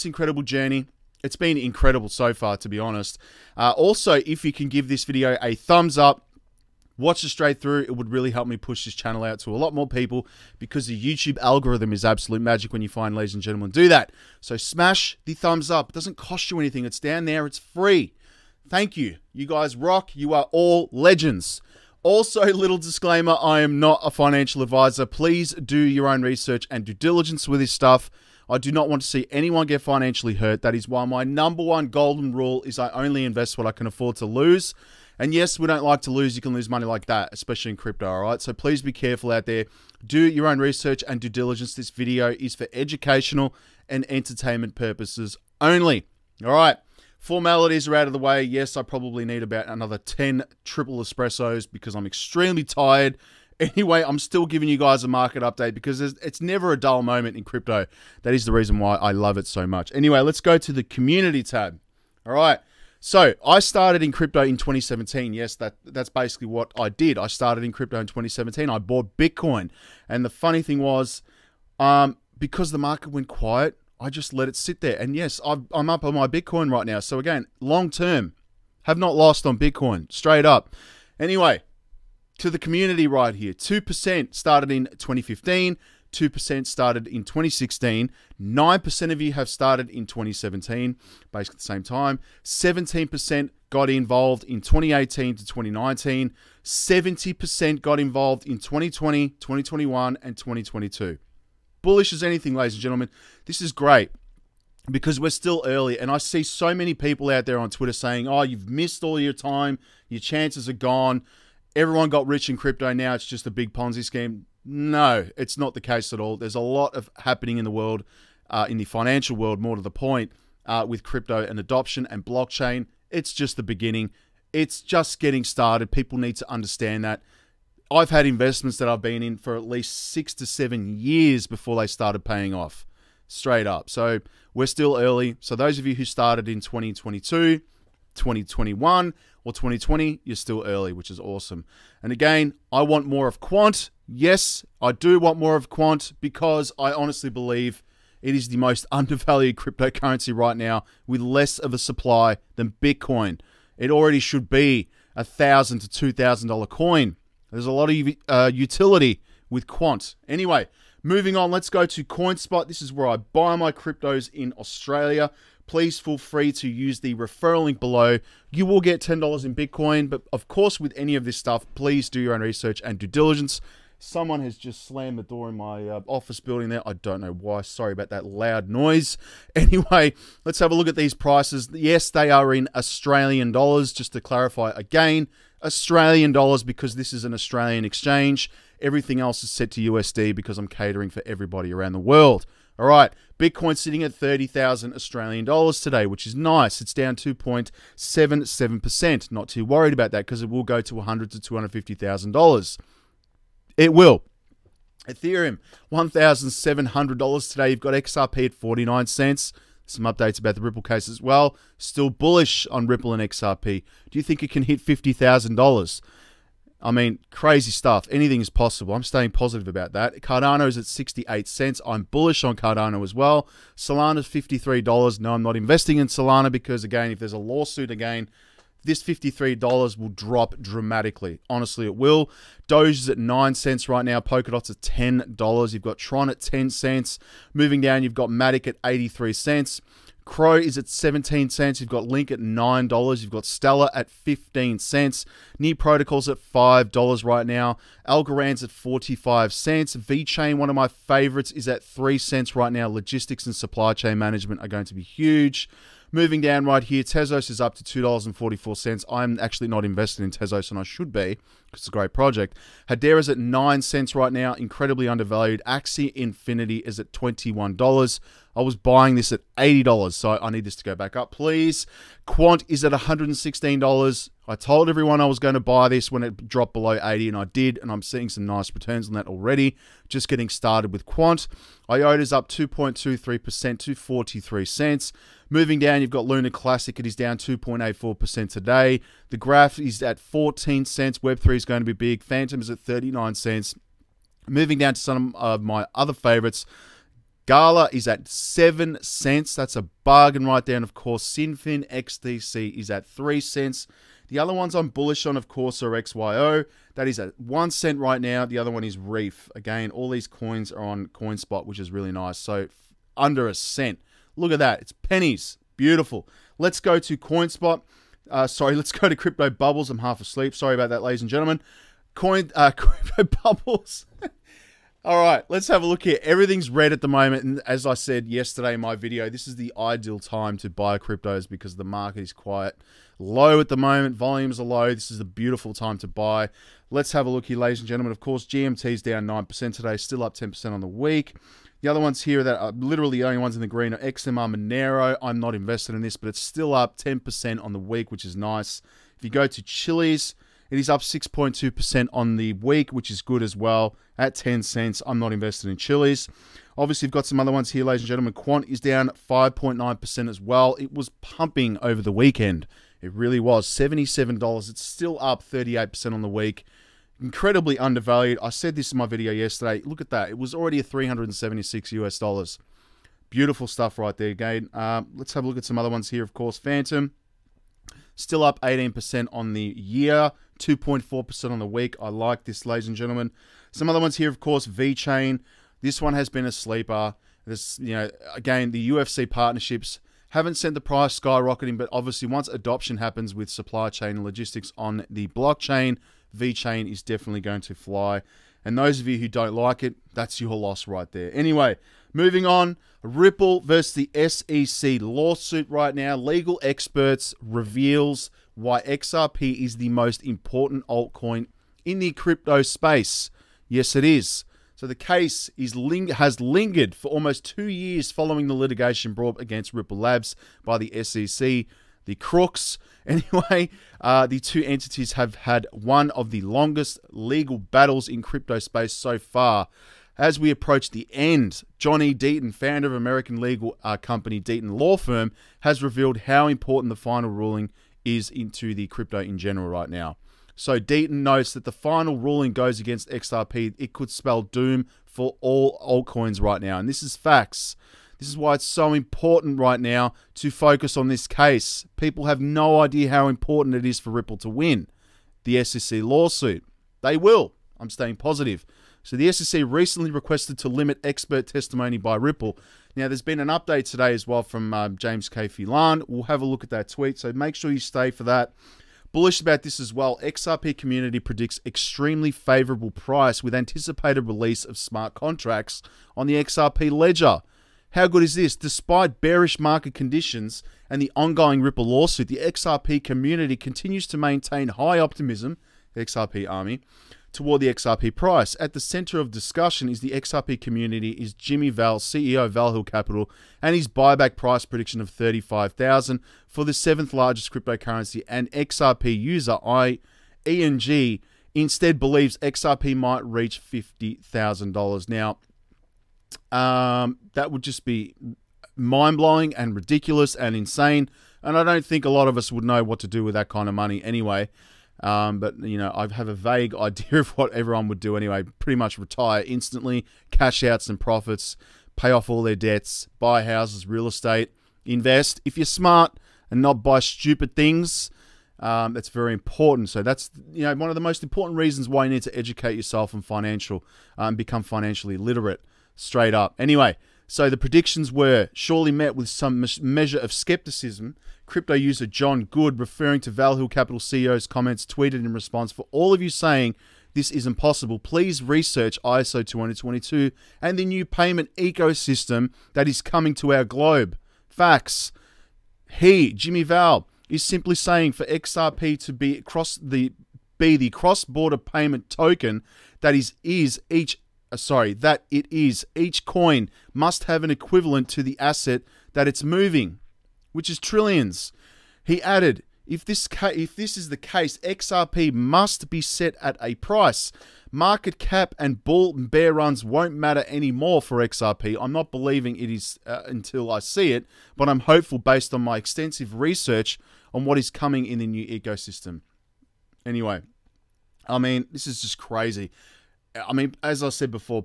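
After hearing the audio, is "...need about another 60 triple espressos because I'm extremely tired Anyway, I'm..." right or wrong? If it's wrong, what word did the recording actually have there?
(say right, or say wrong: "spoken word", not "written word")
wrong: "10", not "60".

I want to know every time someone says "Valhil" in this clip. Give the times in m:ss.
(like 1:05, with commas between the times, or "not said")
8:12, 9:03.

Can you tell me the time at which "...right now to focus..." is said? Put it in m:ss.
7:29.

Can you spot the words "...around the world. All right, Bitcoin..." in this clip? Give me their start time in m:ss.
3:11.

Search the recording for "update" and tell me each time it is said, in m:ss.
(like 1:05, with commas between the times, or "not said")
0:55, 3:30, 7:43.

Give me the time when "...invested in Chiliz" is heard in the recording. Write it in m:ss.
5:55.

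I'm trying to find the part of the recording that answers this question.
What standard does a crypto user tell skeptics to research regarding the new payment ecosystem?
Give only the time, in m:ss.
9:09.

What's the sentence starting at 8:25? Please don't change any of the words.
Now, um, that would just be mind blowing and ridiculous and insane.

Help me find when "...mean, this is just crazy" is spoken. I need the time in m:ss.
9:51.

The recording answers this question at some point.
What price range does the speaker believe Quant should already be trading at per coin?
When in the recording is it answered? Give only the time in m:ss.
2:35.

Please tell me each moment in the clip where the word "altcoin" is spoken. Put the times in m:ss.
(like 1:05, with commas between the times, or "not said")
6:50, 7:25.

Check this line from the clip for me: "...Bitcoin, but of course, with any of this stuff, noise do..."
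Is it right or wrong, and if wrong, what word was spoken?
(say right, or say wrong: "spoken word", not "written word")
wrong: "please", not "noise".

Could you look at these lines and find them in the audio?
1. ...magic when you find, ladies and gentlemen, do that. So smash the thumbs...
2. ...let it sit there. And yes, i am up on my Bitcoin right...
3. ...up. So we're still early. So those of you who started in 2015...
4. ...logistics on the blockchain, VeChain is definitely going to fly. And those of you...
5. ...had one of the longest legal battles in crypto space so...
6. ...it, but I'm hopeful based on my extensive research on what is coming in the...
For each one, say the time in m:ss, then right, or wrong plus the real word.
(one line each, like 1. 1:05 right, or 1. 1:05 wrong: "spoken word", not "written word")
1. 0:12 right
2. 1:14 right
3. 2:13 wrong: "2022", not "2015"
4. 6:34 right
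5. 7:05 right
6. 9:44 right.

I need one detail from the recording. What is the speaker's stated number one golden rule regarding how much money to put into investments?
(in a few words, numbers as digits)
Only invest what I can afford to lose.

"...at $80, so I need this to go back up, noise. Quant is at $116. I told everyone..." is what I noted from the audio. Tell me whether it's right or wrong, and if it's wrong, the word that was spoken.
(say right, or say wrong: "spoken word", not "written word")
wrong: "please", not "noise".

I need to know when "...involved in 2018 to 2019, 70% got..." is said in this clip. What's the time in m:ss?
1:33.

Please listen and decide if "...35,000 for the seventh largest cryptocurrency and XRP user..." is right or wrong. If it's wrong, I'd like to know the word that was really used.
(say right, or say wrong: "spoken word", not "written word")
right.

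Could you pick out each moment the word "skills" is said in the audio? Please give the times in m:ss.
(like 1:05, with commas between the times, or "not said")
not said.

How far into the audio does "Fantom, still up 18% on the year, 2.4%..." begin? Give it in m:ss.
6:16.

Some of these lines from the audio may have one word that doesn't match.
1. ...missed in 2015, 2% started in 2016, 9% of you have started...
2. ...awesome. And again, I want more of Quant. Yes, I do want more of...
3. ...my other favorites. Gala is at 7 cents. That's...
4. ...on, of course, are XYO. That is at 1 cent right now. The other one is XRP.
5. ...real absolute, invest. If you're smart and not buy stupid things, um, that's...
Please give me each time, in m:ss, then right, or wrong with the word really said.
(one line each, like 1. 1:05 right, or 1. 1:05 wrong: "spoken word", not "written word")
1. 1:24 wrong: "started", not "missed"
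2. 2:21 right
3. 4:55 right
4. 5:05 wrong: "Reef", not "XRP"
5. 8:43 wrong: "estate", not "absolute".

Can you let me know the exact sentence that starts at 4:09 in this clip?
VeChain, one of my favorites, is at 3 cents right now.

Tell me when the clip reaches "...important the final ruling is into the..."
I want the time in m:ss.
7:16.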